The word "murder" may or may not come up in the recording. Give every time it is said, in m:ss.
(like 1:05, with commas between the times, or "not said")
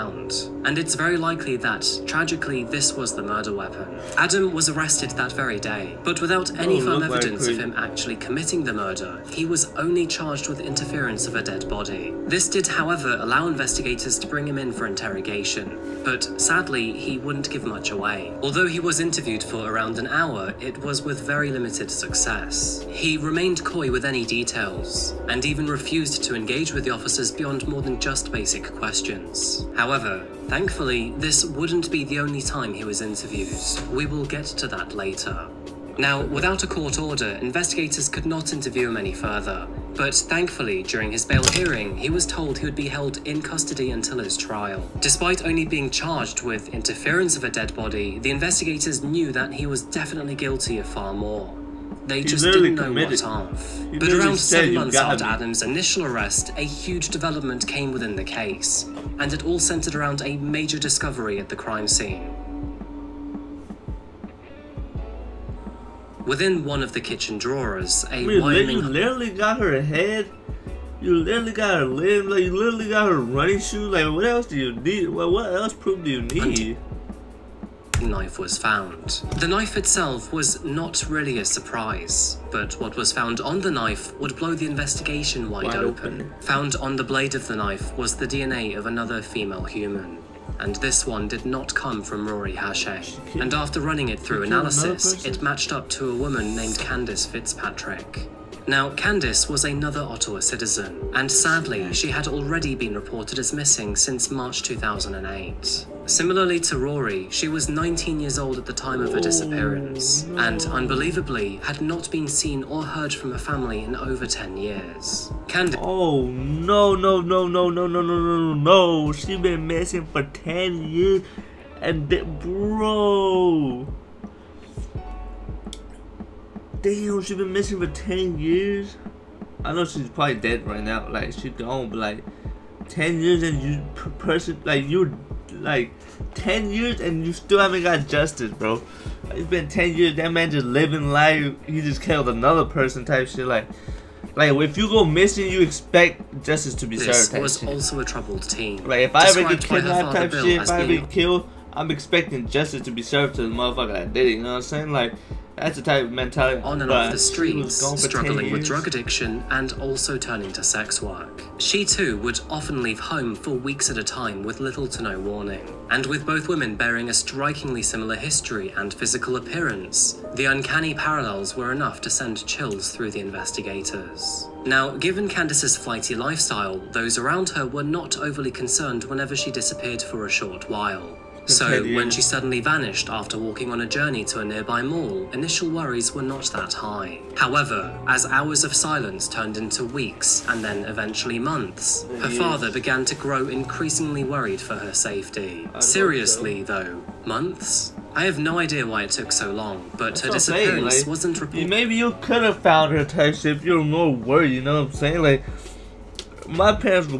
0:03, 0:08.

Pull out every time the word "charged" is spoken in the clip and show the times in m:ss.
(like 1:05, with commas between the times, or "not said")
0:10, 0:45.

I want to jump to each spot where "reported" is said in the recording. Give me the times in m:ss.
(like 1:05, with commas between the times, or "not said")
1:42, 3:21.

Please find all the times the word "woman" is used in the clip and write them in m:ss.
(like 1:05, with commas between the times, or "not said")
1:08, 1:36.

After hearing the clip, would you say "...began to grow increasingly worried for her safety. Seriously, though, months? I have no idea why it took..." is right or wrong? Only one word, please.
right.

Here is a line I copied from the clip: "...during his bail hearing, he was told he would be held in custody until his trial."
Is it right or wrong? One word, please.
right.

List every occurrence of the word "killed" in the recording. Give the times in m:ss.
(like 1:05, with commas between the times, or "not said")
2:22, 2:31.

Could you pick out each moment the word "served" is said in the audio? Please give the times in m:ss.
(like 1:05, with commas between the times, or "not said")
2:27, 2:33.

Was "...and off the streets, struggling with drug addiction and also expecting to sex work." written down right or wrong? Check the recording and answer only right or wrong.
wrong.